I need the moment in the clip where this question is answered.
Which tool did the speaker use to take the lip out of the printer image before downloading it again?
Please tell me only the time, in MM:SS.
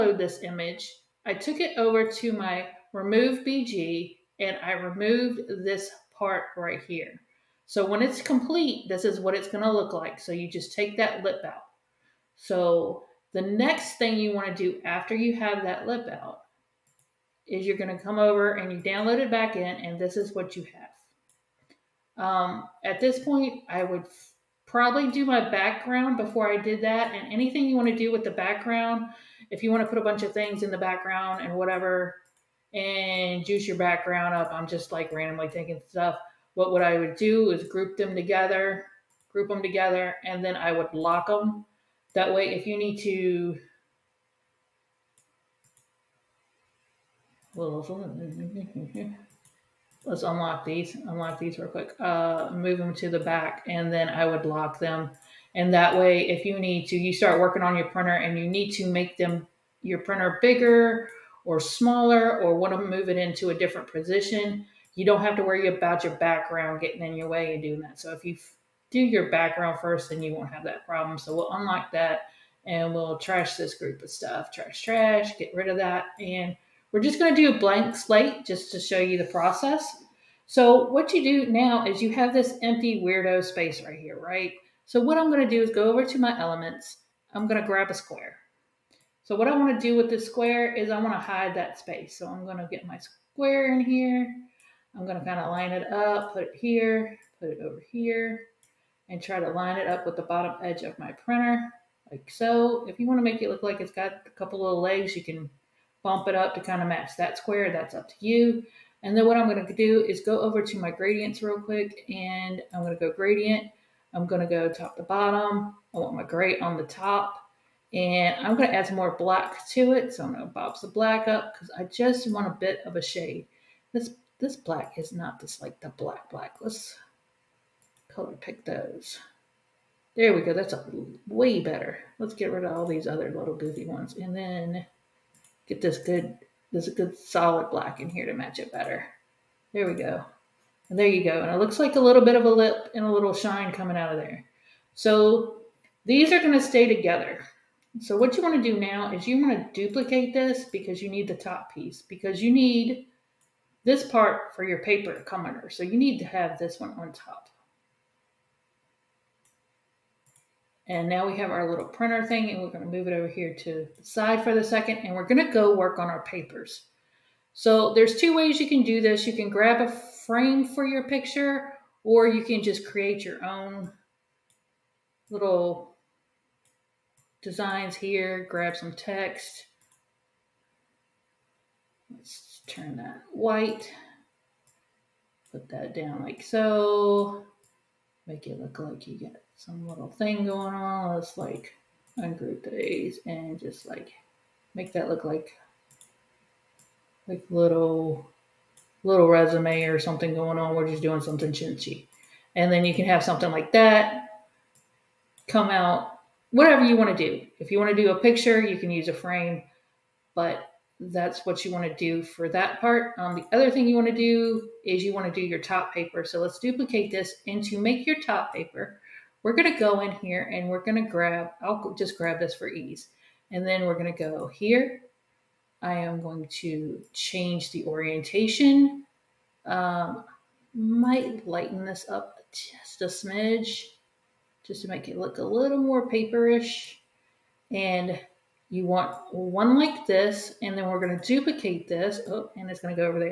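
00:02.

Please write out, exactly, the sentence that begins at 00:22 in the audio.
Um, at this point, I would probably do my background before I did that.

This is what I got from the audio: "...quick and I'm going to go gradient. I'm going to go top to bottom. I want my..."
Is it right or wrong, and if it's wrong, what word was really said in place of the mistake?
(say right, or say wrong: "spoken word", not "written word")
right.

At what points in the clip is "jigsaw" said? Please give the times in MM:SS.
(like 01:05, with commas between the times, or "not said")
not said.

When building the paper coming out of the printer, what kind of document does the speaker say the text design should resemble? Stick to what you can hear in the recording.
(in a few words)
resume.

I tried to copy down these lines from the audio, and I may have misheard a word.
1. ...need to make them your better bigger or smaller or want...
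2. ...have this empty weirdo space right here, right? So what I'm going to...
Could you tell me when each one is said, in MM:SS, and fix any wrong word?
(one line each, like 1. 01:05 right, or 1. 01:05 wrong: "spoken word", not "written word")
1. 00:58 wrong: "printer", not "better"
2. 01:22 right.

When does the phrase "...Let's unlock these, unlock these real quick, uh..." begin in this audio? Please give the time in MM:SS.
00:47.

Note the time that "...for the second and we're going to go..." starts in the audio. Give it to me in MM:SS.
02:44.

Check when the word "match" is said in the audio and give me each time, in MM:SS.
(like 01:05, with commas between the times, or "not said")
01:46, 02:18.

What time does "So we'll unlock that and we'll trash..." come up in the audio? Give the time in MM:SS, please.
01:11.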